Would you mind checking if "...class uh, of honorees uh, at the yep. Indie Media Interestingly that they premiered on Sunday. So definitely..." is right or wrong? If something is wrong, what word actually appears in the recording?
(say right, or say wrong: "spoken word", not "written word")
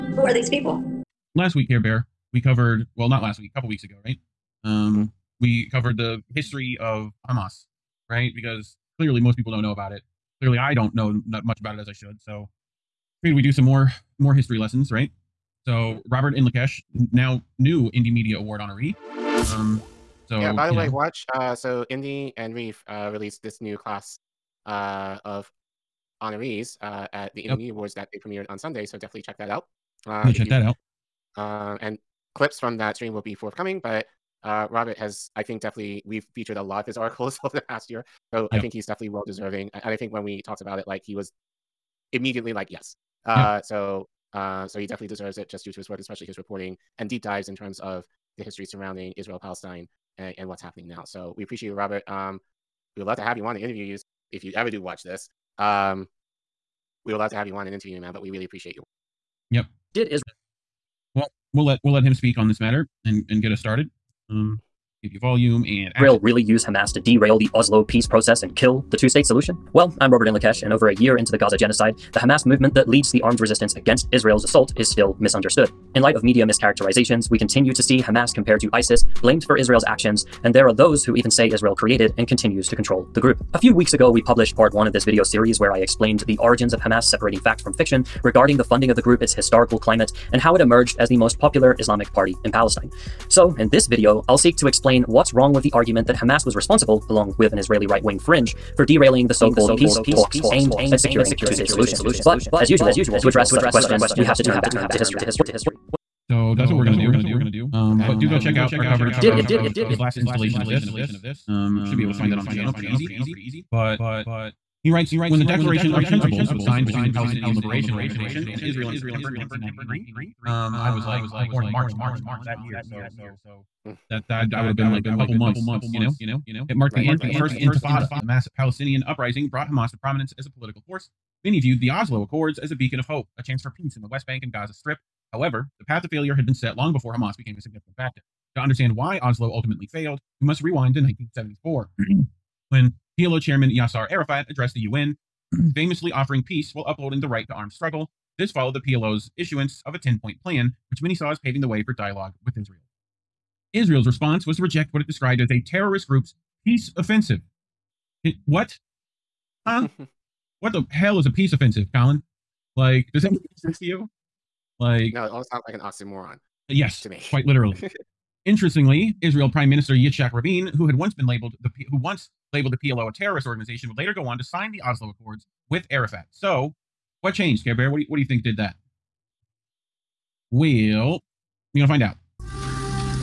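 wrong: "Awards", not "Interestingly".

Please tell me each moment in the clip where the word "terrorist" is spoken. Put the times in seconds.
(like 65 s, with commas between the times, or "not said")
155 s, 173 s.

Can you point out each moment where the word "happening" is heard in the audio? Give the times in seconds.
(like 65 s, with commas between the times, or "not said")
50 s.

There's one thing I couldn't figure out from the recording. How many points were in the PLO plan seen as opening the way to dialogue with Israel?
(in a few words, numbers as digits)
10.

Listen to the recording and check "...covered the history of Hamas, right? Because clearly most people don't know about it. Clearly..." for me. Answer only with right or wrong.
right.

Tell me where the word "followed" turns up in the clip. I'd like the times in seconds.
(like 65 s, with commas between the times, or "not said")
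148 s.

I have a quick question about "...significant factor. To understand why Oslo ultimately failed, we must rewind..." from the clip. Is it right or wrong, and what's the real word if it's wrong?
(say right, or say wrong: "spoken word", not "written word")
right.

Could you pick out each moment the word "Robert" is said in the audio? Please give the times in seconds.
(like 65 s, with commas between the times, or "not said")
16 s, 34 s, 51 s, 70 s.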